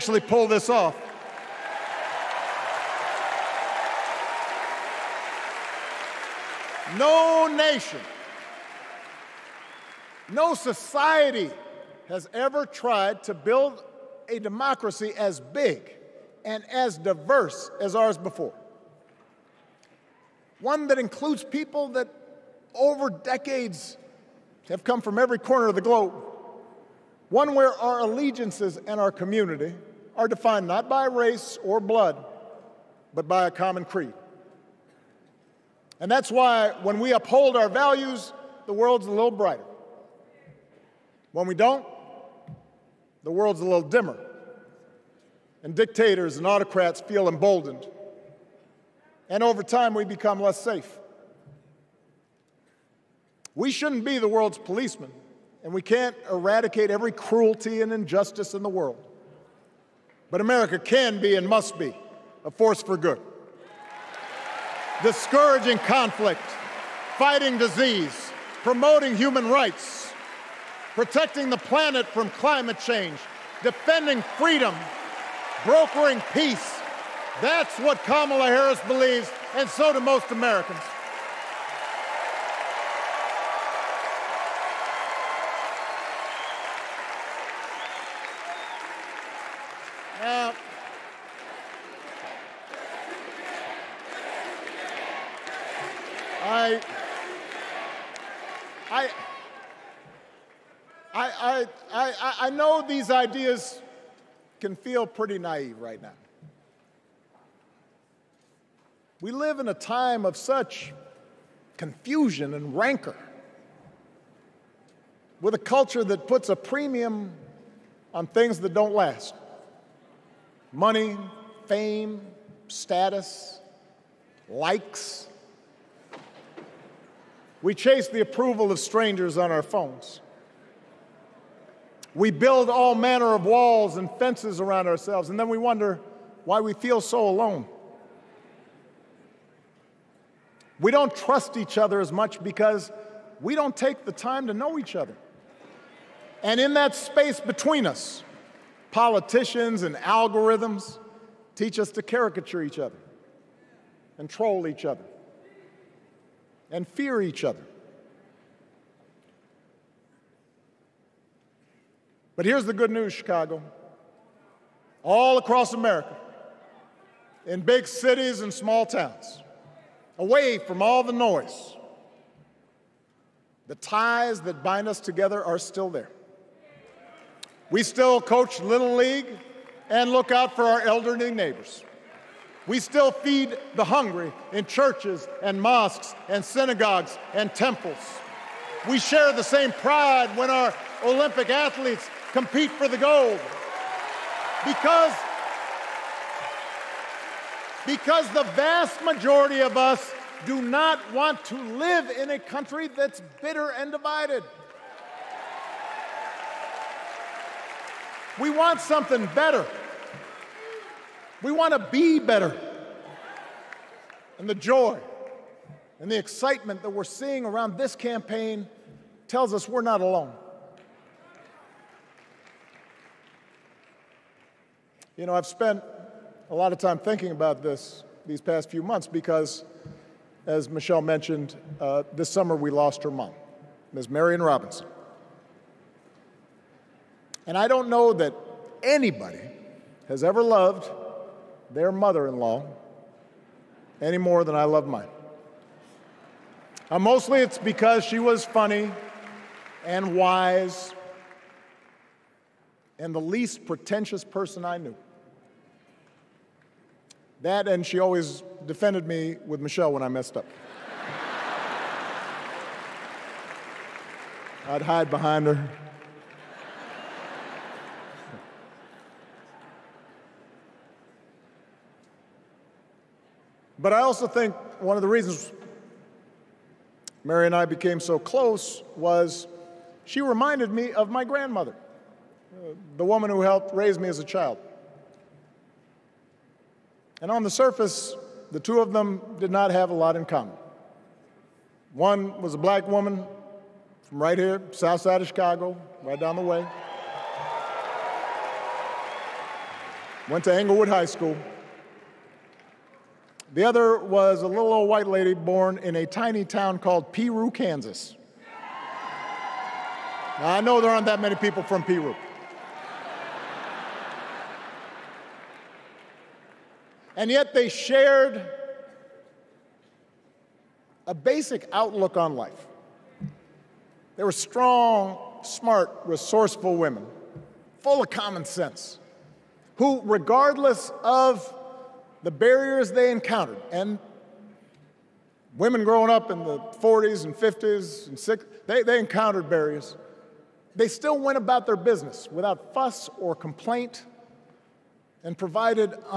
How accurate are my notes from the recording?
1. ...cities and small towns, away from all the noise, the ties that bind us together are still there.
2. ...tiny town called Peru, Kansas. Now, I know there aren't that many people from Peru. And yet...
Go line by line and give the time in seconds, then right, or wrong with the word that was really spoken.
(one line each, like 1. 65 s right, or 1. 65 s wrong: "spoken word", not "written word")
1. 167 s right
2. 306 s right.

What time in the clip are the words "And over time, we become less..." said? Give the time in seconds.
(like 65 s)
49 s.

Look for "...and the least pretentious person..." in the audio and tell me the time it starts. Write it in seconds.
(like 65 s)
252 s.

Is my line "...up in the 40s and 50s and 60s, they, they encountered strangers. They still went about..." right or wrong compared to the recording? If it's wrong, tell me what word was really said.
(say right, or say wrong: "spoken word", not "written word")
wrong: "barriers", not "strangers".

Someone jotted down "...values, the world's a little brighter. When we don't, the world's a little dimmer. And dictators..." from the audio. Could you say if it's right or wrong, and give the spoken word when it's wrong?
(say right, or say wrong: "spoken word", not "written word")
right.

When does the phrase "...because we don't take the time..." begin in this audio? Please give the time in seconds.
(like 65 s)
142 s.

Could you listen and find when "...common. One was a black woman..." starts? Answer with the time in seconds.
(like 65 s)
290 s.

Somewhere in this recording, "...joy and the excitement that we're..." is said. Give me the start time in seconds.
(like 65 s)
214 s.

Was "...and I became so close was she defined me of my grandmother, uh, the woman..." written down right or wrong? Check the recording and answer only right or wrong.
wrong.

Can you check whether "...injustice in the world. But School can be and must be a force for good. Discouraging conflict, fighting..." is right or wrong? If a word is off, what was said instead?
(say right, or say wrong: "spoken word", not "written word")
wrong: "America", not "School".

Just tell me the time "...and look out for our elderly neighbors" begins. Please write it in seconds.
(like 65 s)
179 s.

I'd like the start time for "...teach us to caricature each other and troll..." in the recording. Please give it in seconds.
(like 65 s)
151 s.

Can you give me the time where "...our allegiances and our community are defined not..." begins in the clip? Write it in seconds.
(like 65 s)
27 s.